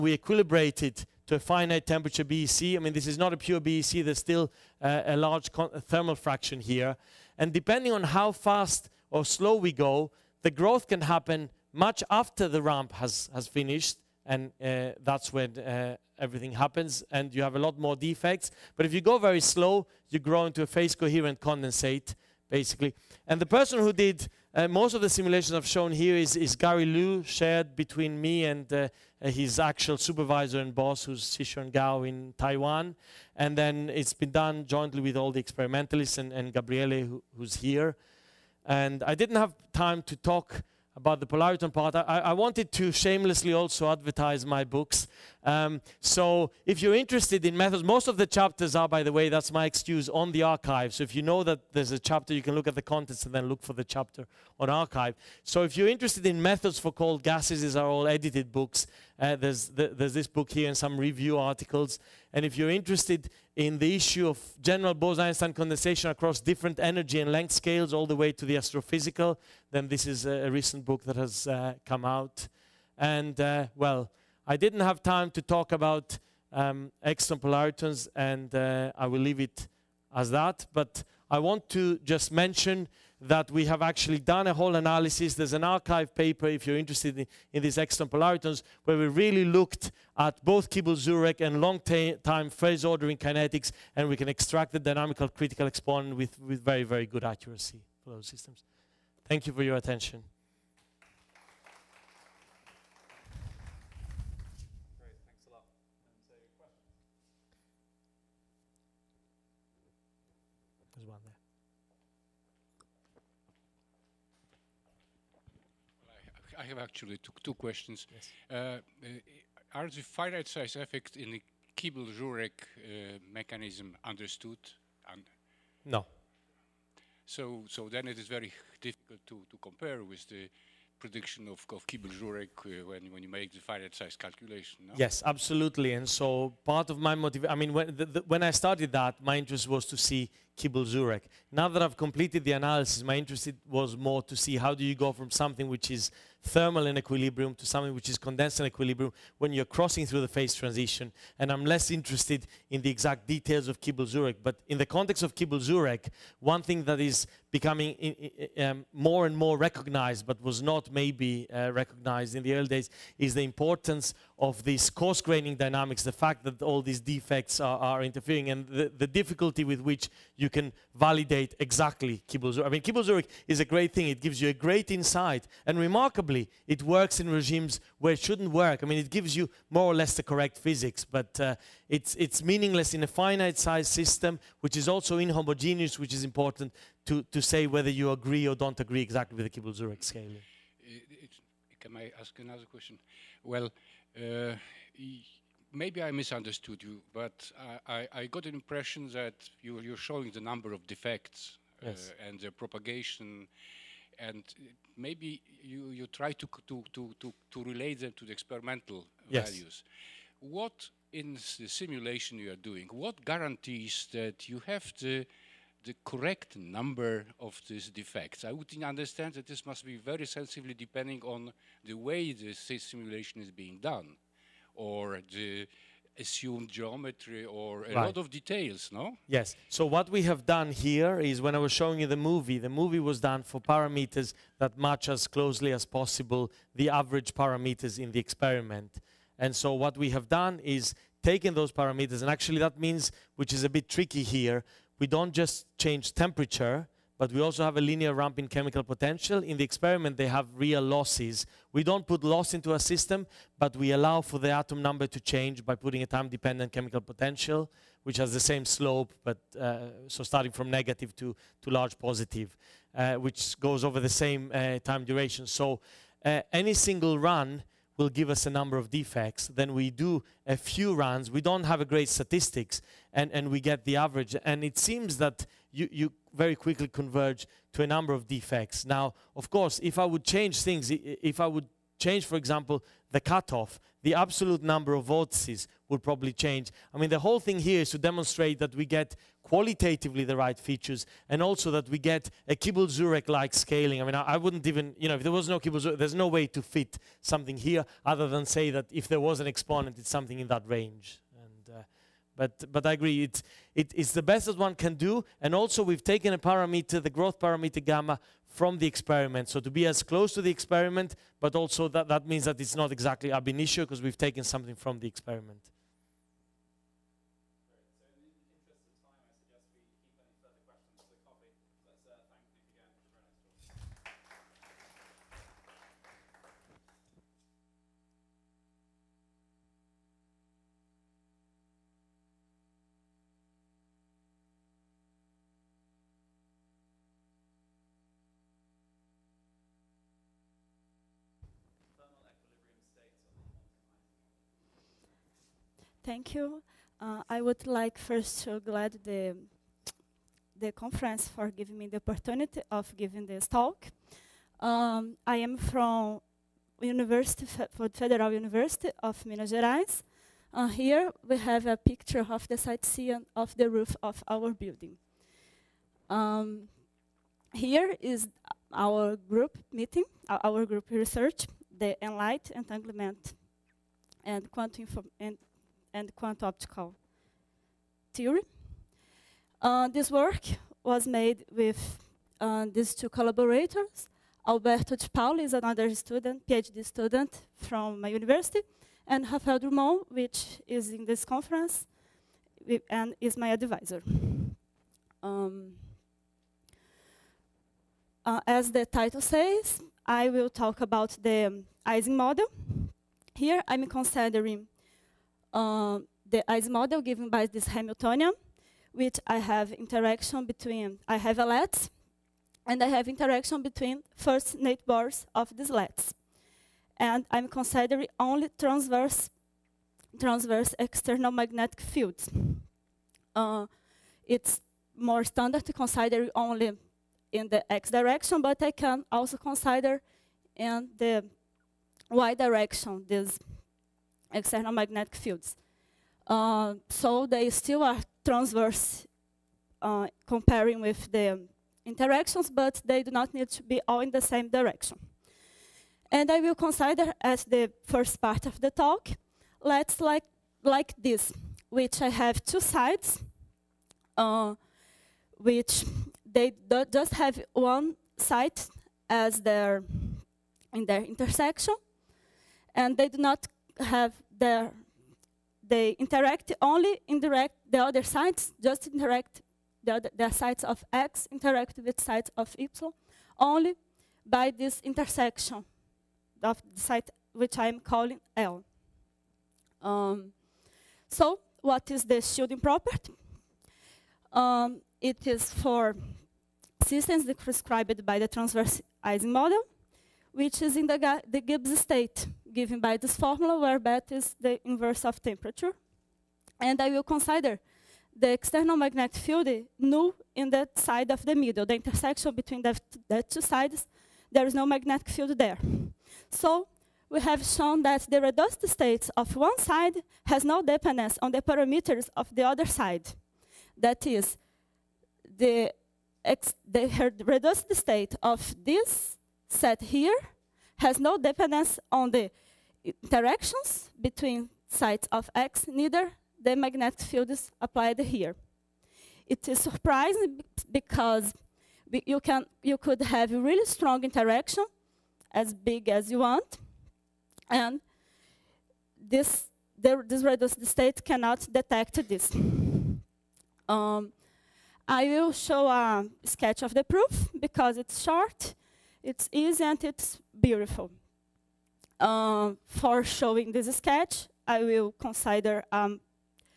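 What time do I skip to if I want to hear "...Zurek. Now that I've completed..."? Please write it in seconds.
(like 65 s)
140 s.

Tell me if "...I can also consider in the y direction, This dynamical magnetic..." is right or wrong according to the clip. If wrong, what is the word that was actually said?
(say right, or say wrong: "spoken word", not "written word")
wrong: "external", not "dynamical".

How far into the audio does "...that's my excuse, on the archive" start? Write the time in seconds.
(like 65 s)
49 s.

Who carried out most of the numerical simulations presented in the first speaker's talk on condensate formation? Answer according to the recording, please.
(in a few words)
Gary Liu.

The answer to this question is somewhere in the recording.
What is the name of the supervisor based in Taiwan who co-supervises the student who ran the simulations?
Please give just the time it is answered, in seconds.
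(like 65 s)
31 s.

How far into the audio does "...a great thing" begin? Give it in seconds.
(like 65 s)
173 s.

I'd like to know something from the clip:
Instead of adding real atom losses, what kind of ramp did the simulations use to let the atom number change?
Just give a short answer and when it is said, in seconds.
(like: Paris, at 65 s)
linear ramp in chemical potential, at 247 s.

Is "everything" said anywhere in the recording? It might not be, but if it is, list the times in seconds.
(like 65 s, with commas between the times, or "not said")
16 s.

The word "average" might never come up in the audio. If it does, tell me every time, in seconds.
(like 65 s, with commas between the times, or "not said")
236 s, 273 s.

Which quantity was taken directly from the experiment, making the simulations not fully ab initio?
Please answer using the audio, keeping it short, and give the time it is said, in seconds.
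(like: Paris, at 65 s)
growth parameter gamma, at 307 s.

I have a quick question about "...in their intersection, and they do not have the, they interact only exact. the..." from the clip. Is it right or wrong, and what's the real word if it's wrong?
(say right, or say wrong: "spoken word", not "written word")
wrong: "indirect", not "exact".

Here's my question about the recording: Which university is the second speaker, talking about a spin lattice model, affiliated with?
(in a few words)
Federal University of Minas Gerais.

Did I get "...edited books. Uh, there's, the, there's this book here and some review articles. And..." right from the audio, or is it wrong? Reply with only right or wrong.
right.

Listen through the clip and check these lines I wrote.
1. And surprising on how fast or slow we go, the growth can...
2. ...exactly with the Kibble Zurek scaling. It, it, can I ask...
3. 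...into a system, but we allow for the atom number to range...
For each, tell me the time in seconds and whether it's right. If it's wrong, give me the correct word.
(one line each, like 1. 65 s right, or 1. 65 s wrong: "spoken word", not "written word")
1. 7 s wrong: "depending", not "surprising"
2. 189 s right
3. 252 s wrong: "change", not "range".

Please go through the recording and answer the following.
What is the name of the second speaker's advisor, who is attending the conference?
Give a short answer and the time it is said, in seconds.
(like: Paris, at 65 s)
Raphael Drumond, at 389 s.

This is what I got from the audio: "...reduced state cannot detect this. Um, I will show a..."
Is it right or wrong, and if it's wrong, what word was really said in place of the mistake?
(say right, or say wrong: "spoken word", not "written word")
right.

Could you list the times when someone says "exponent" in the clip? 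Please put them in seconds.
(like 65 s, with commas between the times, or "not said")
95 s, 299 s.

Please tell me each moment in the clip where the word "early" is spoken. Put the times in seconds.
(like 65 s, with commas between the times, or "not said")
162 s.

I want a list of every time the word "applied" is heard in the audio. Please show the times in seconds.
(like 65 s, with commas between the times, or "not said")
527 s.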